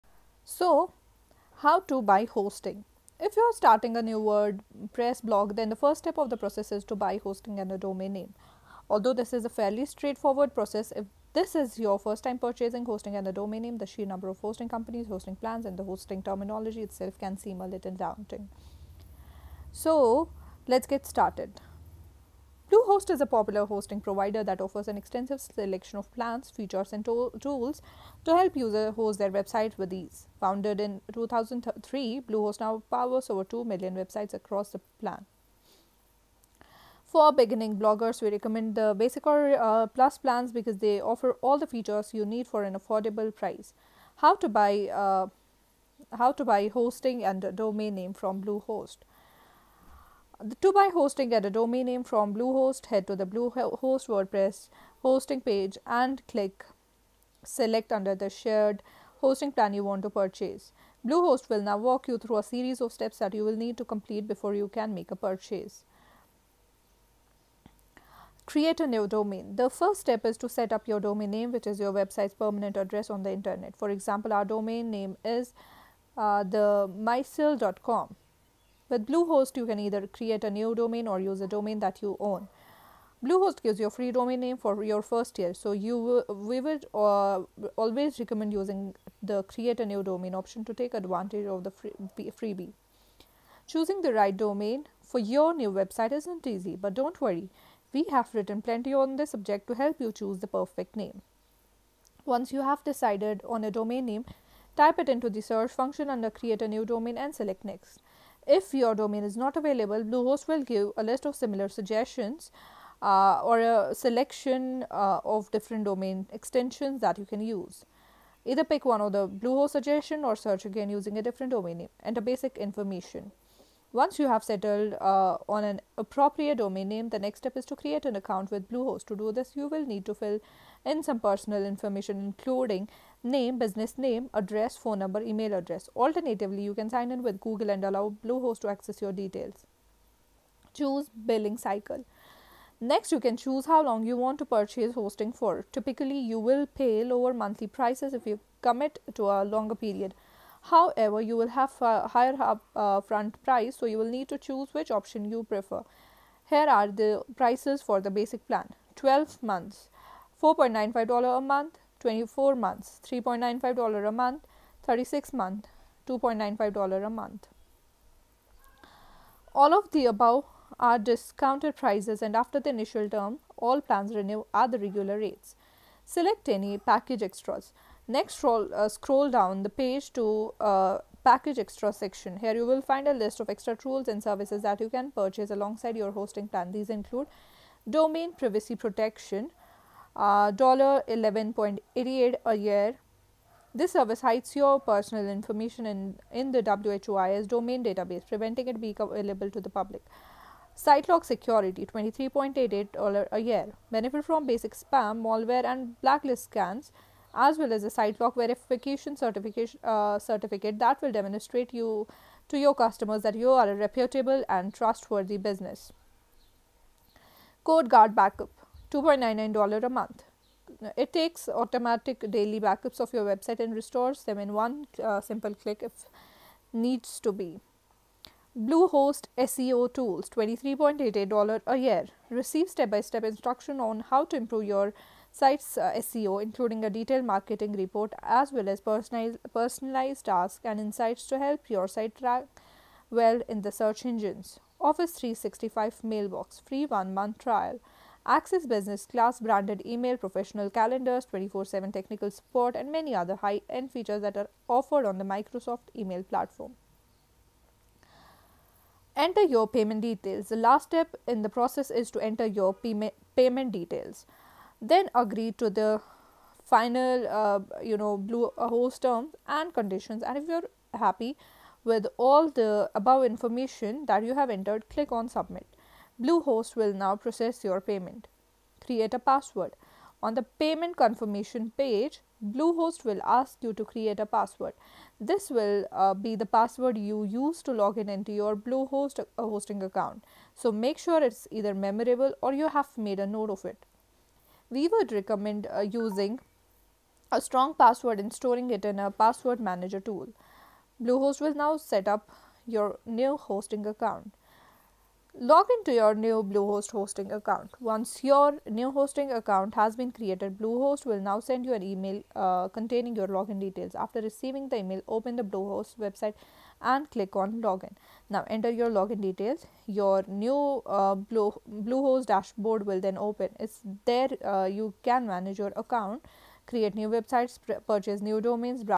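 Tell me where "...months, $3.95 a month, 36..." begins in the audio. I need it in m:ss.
2:42.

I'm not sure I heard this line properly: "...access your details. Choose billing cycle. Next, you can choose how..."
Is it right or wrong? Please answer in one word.
right.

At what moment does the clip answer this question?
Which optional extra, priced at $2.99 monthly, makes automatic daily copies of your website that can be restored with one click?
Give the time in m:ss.
3:37.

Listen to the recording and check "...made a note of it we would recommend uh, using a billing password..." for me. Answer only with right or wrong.
wrong.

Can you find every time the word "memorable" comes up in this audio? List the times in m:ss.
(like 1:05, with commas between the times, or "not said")
4:51.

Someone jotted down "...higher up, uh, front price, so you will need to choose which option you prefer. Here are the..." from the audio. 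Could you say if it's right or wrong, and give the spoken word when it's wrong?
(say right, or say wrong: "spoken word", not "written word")
right.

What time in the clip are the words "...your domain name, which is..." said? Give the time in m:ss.
1:10.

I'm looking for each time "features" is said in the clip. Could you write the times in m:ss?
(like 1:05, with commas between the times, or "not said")
0:26, 0:41, 4:13.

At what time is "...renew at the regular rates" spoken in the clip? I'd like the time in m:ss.
2:54.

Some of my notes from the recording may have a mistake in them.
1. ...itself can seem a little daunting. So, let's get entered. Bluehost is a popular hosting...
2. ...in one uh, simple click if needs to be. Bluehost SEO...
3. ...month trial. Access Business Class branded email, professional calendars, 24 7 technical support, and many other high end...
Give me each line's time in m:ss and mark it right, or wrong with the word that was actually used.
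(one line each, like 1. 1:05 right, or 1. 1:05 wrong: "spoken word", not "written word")
1. 0:16 wrong: "started", not "entered"
2. 3:44 right
3. 4:07 right.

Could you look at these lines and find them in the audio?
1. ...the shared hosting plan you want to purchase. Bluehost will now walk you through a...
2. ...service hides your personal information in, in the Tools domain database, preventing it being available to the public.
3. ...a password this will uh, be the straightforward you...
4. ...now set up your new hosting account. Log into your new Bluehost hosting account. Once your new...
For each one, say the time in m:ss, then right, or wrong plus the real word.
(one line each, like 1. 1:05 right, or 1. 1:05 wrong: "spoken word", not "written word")
1. 0:58 right
2. 3:13 wrong: "WHOIS", not "Tools"
3. 4:44 wrong: "password", not "straightforward"
4. 5:01 right.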